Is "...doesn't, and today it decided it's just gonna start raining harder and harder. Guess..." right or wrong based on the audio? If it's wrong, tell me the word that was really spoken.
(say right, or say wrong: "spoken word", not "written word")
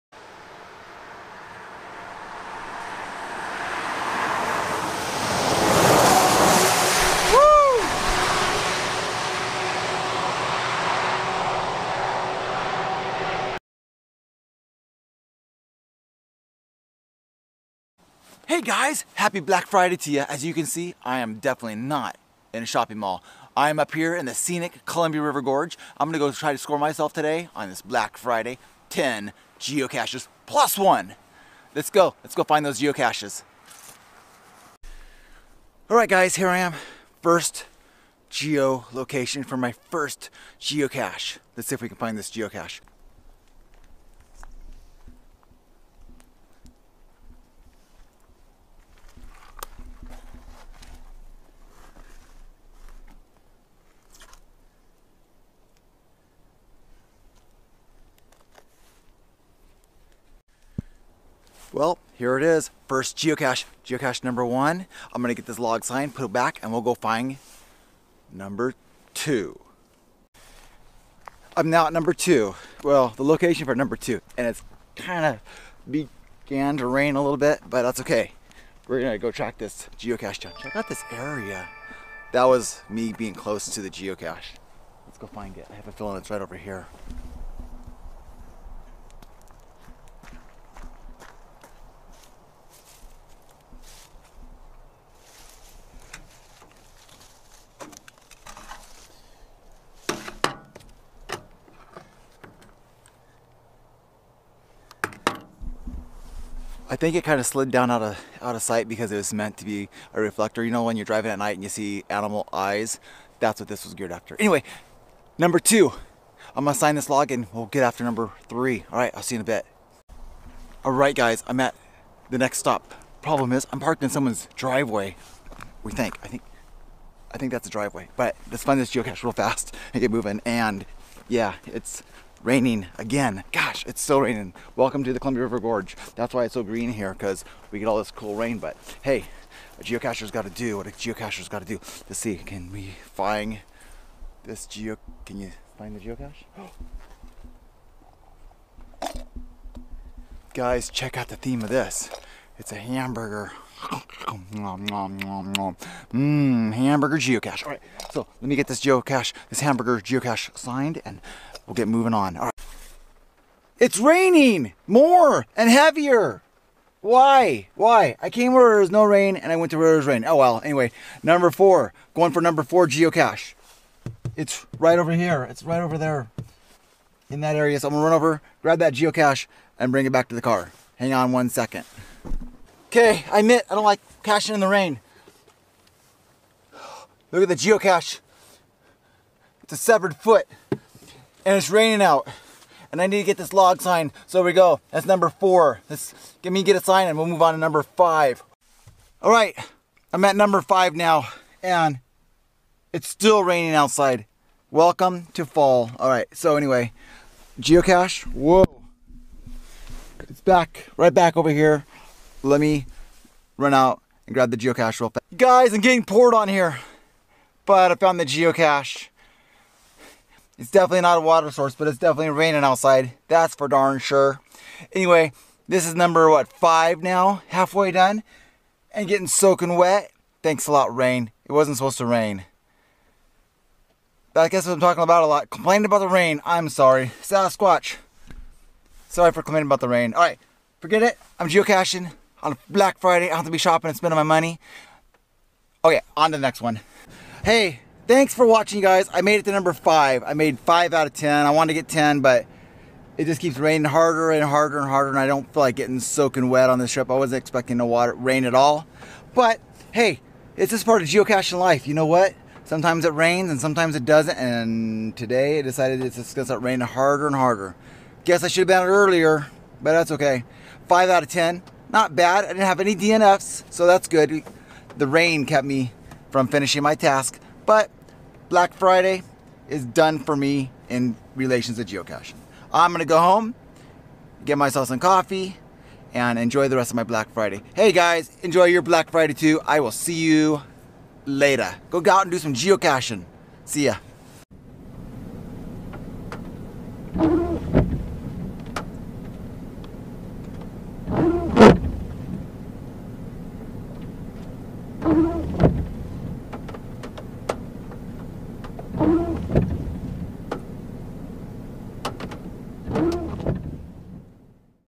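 right.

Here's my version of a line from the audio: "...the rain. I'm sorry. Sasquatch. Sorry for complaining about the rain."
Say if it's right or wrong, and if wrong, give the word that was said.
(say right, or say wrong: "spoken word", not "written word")
right.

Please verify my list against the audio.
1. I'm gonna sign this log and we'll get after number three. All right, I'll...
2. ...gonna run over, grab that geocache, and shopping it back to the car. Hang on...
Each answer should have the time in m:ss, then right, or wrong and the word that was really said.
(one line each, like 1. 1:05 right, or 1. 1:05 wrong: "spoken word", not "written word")
1. 1:56 right
2. 2:57 wrong: "bring", not "shopping".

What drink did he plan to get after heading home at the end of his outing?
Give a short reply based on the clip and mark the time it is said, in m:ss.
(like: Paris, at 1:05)
Coffee, at 4:44.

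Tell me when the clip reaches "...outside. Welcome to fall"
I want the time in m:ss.
3:23.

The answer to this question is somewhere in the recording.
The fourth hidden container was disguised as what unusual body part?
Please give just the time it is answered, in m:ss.
3:09.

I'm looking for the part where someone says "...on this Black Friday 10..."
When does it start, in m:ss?
0:27.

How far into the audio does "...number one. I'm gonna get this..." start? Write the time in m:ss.
1:04.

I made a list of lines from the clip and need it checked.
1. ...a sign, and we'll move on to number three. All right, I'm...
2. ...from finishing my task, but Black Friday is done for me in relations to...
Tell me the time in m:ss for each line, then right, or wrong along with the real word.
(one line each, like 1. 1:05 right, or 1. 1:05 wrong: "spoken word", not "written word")
1. 3:16 wrong: "five", not "three"
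2. 4:36 right.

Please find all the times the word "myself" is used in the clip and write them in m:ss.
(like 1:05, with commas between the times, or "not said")
0:26, 4:44.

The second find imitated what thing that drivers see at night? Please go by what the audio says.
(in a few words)
Animal eyes.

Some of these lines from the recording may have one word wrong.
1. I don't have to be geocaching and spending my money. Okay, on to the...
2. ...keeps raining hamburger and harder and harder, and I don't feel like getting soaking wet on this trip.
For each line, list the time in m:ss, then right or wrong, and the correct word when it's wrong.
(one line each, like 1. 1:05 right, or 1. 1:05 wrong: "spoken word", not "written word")
1. 4:03 wrong: "shopping", not "geocaching"
2. 4:13 wrong: "harder", not "hamburger".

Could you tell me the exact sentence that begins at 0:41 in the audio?
Let's see if we can find this geocache.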